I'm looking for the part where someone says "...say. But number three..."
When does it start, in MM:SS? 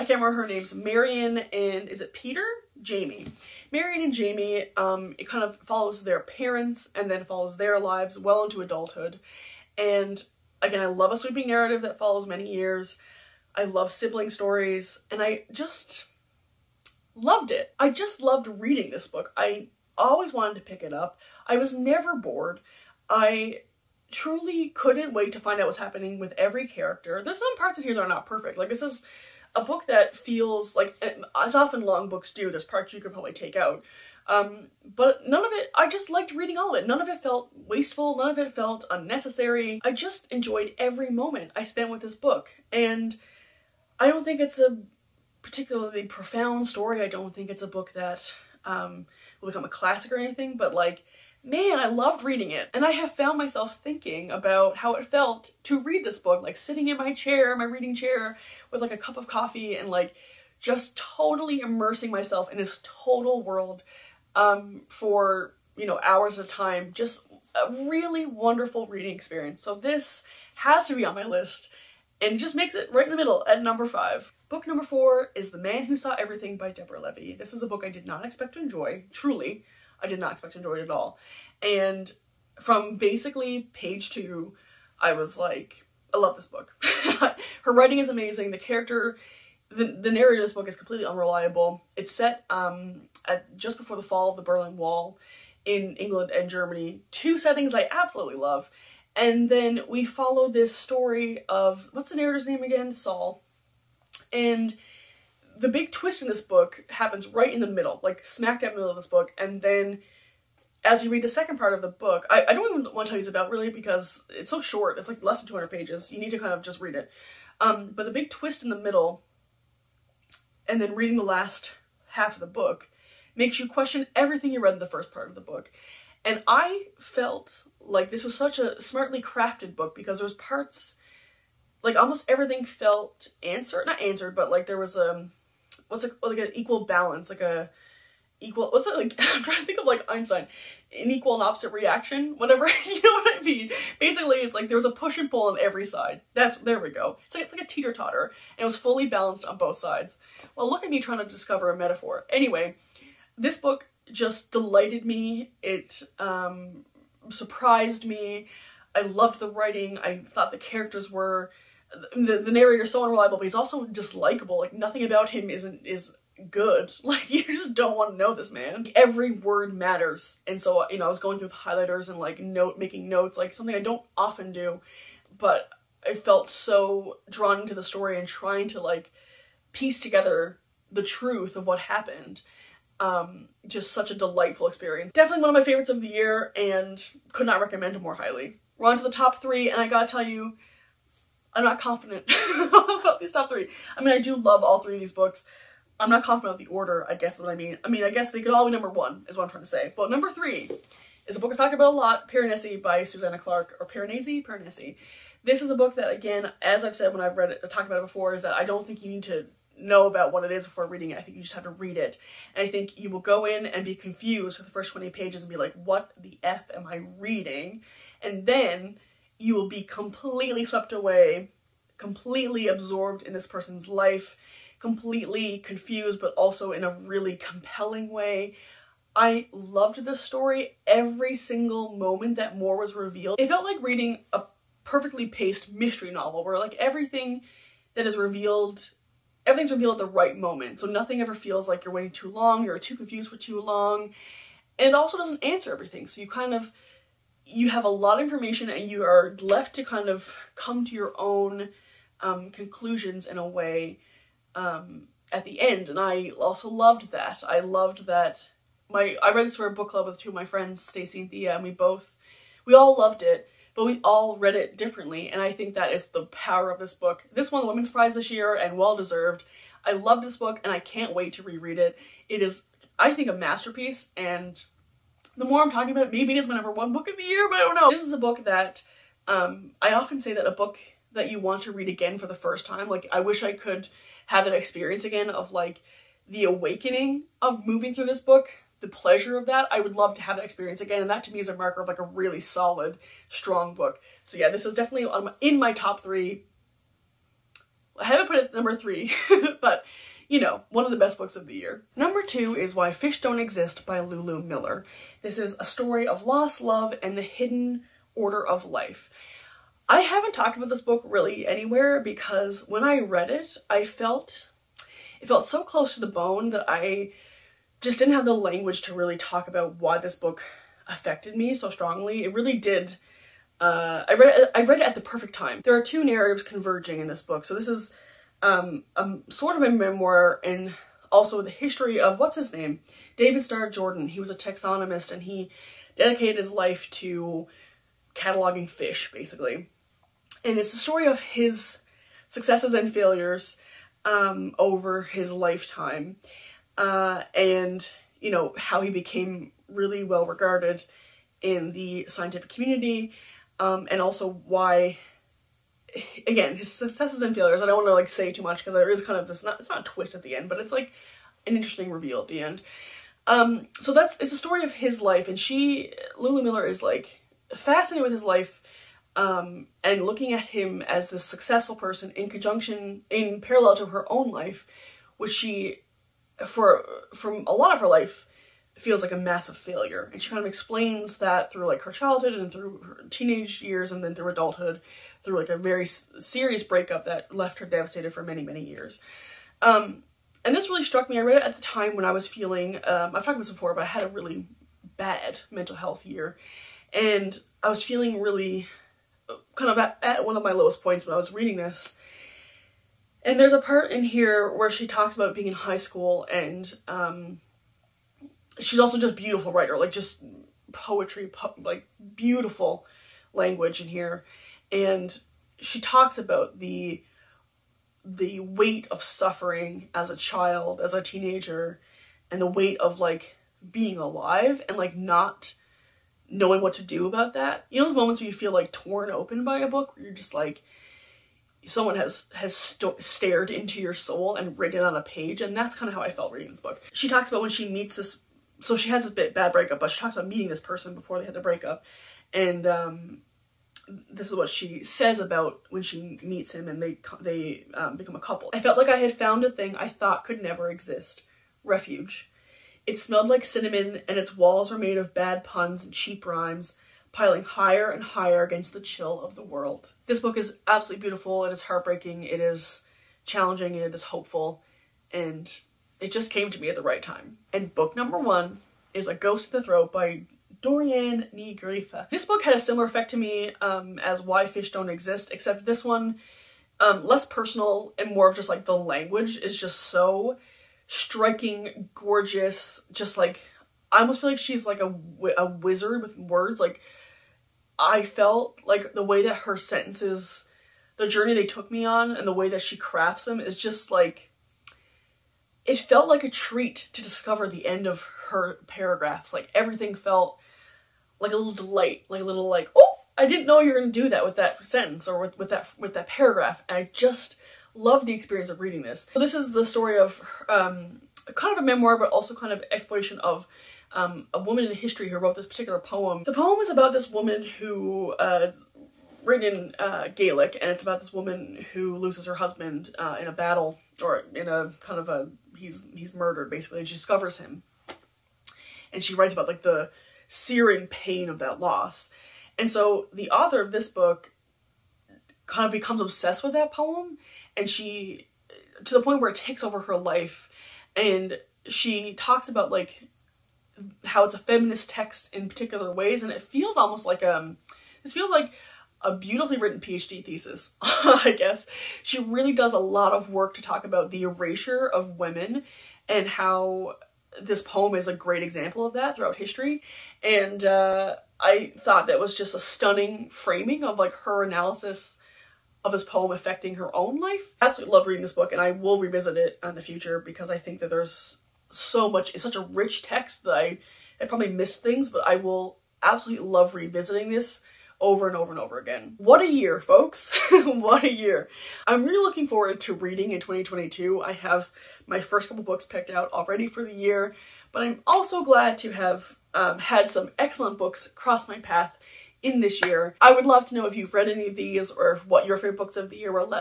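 03:19.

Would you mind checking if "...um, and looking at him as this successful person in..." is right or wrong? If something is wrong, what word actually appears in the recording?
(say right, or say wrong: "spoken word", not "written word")
right.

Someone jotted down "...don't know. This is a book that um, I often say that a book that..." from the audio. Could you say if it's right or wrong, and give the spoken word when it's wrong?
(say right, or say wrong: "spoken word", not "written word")
right.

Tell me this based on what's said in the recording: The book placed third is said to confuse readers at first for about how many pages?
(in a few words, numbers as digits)
20.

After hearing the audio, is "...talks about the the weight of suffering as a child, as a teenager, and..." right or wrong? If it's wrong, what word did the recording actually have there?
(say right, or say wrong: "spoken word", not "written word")
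right.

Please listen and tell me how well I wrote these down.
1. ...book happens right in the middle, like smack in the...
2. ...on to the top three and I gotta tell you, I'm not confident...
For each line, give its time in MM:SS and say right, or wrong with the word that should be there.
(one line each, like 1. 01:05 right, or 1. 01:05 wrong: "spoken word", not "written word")
1. 01:46 right
2. 03:08 right.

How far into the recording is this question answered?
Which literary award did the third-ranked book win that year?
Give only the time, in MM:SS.
04:27.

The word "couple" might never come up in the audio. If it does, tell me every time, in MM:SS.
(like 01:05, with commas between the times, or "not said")
07:28, 09:45.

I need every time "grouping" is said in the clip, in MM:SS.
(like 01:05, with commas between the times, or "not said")
not said.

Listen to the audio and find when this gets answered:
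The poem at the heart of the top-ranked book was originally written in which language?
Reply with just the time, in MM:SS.
08:40.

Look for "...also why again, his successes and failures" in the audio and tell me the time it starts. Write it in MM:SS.
05:54.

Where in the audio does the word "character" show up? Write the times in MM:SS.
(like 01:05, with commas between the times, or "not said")
00:26, 01:28, 02:40.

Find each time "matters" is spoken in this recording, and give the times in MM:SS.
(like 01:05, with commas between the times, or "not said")
02:49.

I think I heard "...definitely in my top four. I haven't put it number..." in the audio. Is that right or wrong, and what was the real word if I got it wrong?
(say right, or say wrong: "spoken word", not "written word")
wrong: "three", not "four".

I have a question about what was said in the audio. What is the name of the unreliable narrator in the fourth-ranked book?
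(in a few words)
Saul.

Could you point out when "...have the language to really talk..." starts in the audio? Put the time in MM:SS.
05:18.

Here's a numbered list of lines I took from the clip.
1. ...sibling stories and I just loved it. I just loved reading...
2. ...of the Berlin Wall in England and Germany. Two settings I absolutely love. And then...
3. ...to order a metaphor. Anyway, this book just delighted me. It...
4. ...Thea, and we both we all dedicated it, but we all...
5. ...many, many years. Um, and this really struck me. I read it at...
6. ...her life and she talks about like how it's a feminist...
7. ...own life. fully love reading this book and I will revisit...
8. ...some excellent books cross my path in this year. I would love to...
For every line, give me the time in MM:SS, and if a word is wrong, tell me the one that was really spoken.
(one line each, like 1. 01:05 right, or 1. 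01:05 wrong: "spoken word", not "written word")
1. 00:13 right
2. 01:34 right
3. 02:31 wrong: "discover", not "order"
4. 04:21 wrong: "loved", not "dedicated"
5. 06:28 right
6. 08:59 right
7. 09:26 wrong: "absolutely", not "fully"
8. 09:50 right.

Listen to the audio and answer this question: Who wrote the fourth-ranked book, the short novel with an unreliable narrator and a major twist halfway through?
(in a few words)
Deborah Levy.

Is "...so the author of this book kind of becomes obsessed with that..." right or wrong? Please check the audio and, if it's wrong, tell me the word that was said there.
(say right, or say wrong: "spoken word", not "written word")
right.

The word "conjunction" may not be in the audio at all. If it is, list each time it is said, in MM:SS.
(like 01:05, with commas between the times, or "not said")
06:12.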